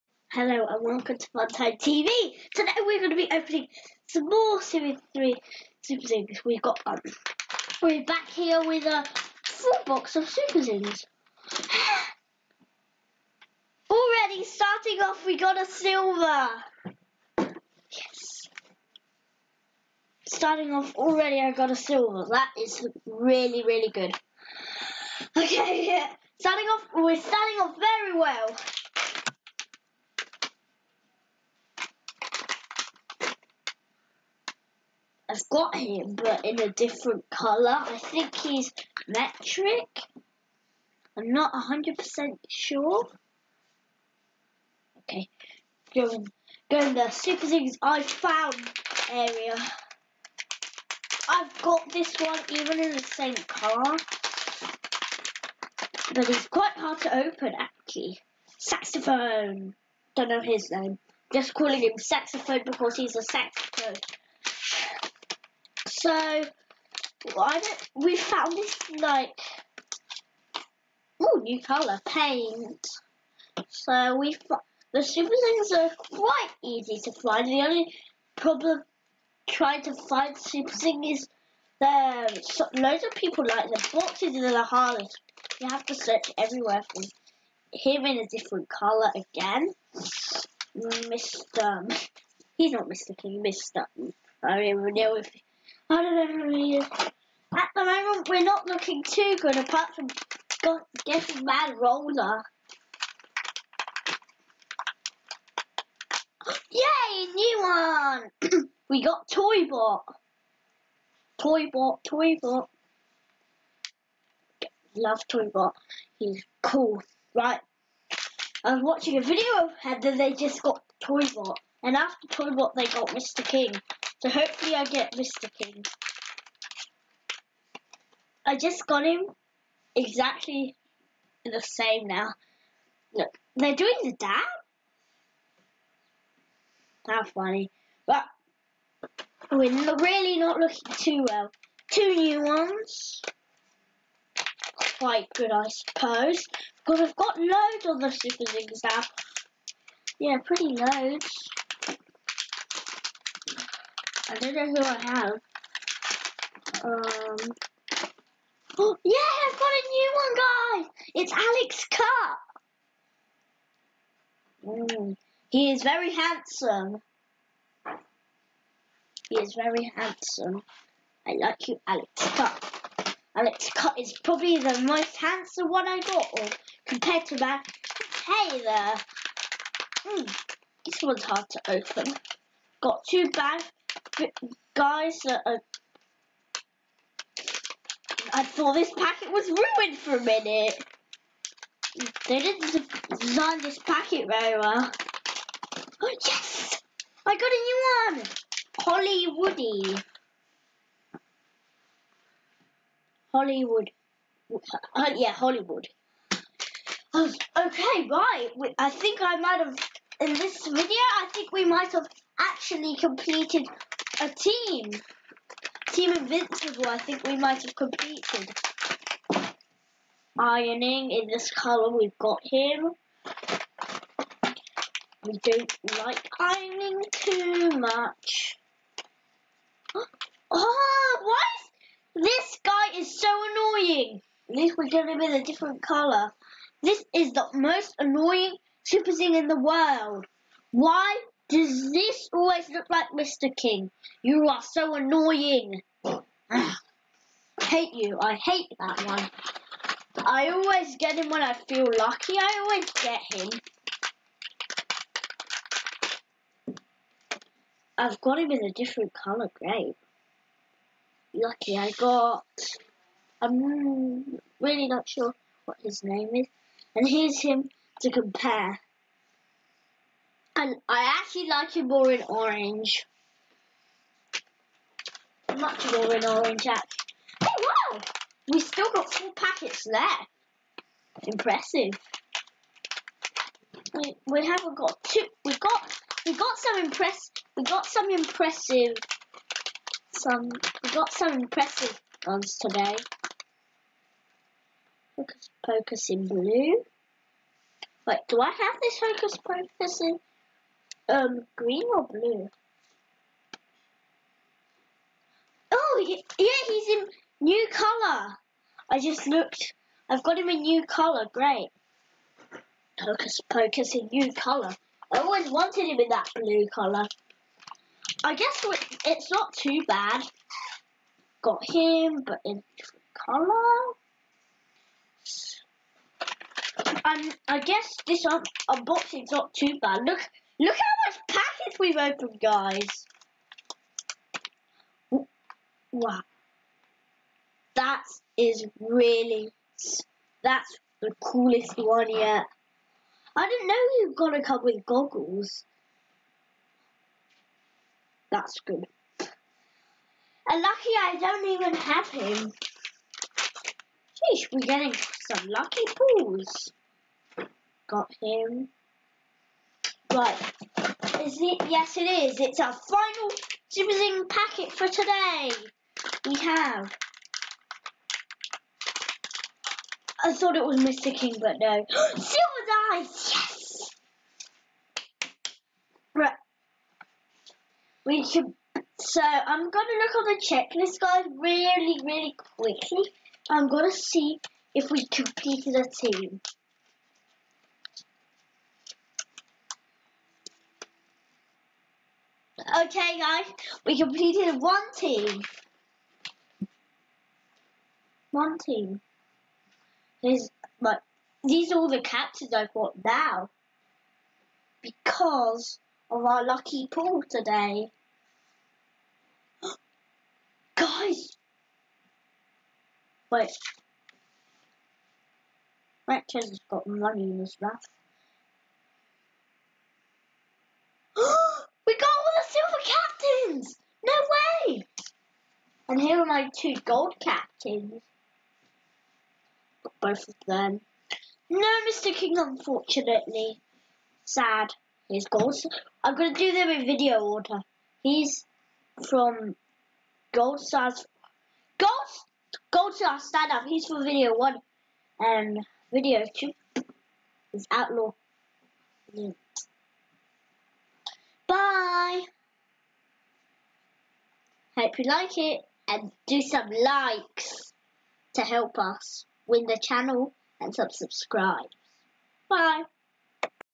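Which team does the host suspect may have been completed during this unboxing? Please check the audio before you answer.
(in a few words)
Team Invincible.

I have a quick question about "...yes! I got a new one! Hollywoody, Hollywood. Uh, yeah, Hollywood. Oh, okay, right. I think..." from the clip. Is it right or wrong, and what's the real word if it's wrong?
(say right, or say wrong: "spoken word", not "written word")
right.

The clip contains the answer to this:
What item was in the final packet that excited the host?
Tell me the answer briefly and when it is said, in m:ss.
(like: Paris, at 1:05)
Silver dice, at 6:11.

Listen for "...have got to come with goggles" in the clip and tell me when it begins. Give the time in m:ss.
5:44.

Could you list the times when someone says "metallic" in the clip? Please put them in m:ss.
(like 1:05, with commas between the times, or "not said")
not said.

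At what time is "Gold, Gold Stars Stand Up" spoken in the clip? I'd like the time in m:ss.
7:21.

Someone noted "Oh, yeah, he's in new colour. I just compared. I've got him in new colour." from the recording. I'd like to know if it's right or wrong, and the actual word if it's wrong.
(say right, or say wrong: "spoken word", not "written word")
wrong: "looked", not "compared".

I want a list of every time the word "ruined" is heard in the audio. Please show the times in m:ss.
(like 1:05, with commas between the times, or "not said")
3:09.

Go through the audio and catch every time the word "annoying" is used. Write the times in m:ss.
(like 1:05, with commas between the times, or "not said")
3:53, 3:57, 4:04.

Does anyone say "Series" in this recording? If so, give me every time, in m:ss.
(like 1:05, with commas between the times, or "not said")
0:04.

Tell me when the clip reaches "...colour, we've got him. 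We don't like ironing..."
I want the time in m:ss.
3:41.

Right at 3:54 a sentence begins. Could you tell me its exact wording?
At least we get him in a different colour.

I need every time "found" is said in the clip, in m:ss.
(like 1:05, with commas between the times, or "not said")
0:48, 1:08.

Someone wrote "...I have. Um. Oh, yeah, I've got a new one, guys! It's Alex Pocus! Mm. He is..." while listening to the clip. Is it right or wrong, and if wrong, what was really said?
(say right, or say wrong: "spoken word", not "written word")
wrong: "Cut", not "Pocus".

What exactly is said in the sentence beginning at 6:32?
Okay, guys, we completed one team.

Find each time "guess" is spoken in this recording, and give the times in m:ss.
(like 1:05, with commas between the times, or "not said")
5:18, 5:27.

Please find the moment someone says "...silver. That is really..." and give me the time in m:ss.
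0:21.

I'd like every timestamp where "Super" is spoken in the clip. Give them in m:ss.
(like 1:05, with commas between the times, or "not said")
0:05, 0:10, 0:47, 1:15, 1:20, 2:28, 3:58.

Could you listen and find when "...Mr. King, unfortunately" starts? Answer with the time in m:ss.
7:11.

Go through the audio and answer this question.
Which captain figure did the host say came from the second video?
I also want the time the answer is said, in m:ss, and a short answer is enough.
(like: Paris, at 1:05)
Outlaw, at 7:27.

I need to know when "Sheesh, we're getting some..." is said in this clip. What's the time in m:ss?
5:54.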